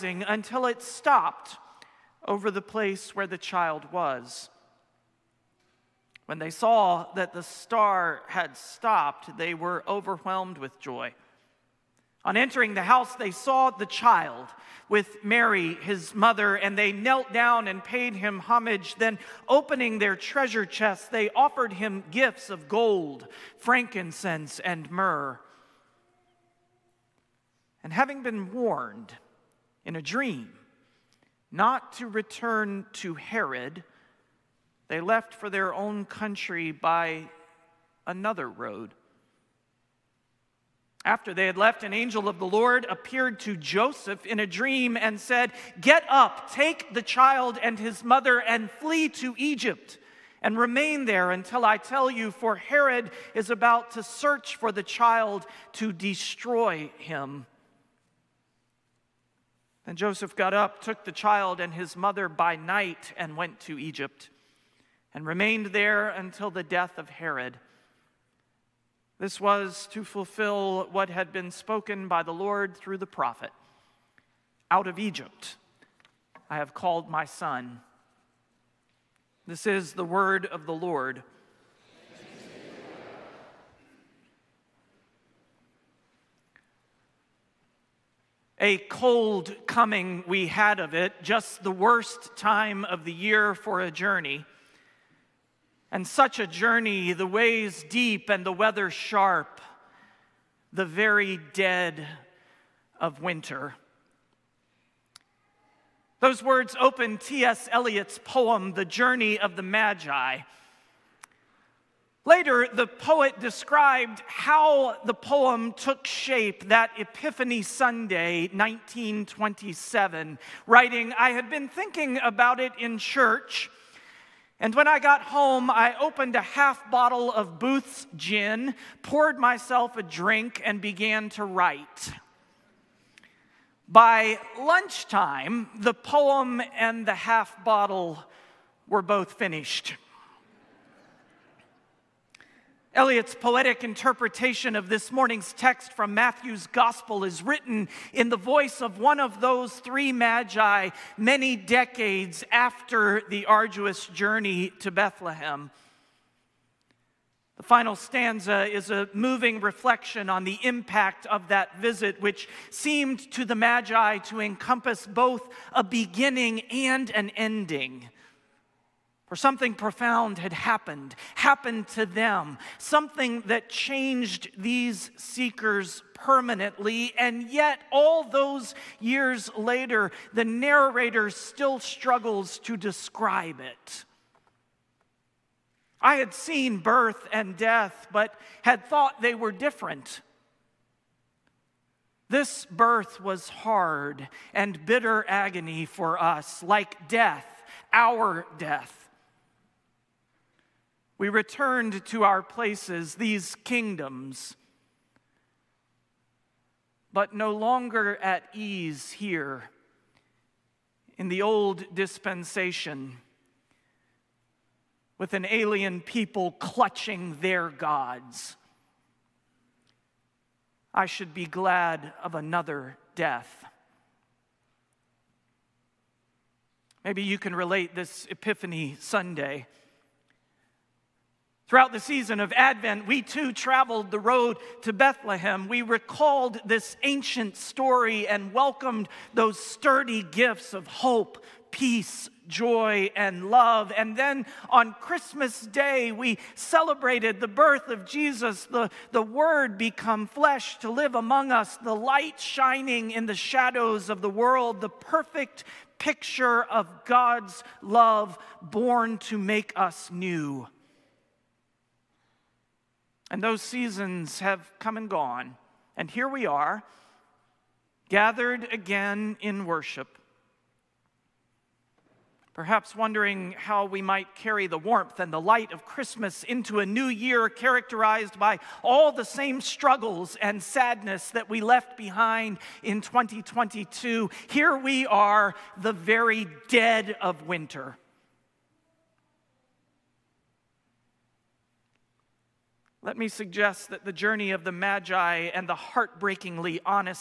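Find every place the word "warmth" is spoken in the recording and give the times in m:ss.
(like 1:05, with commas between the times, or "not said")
4:34.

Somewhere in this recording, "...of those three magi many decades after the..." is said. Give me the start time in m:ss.
2:29.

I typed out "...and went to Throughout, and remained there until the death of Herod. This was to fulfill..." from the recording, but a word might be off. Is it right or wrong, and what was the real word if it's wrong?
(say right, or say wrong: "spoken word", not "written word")
wrong: "Egypt", not "Throughout".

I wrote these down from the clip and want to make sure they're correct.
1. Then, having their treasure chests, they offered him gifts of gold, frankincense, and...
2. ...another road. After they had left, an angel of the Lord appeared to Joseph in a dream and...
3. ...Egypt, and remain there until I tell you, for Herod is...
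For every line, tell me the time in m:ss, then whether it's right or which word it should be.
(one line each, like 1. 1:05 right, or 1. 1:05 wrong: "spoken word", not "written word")
1. 0:18 wrong: "opening", not "having"
2. 0:38 right
3. 0:49 right.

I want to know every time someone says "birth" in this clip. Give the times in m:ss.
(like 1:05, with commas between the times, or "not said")
3:06, 3:12, 4:07.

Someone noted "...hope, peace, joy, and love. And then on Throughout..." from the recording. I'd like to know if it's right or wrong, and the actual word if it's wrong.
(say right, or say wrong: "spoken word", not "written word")
wrong: "Christmas", not "Throughout".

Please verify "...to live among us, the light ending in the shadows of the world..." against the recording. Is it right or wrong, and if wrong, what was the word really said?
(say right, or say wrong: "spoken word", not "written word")
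wrong: "shining", not "ending".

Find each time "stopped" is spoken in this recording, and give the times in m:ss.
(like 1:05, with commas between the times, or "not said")
0:00, 0:08.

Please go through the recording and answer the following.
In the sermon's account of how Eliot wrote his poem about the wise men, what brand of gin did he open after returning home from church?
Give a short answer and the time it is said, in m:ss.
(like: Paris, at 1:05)
Booth's, at 2:07.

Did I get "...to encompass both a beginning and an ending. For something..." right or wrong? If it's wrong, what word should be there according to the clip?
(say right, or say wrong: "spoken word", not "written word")
right.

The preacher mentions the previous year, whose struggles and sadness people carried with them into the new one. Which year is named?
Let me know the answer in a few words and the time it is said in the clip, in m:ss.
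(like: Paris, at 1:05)
2022, at 4:42.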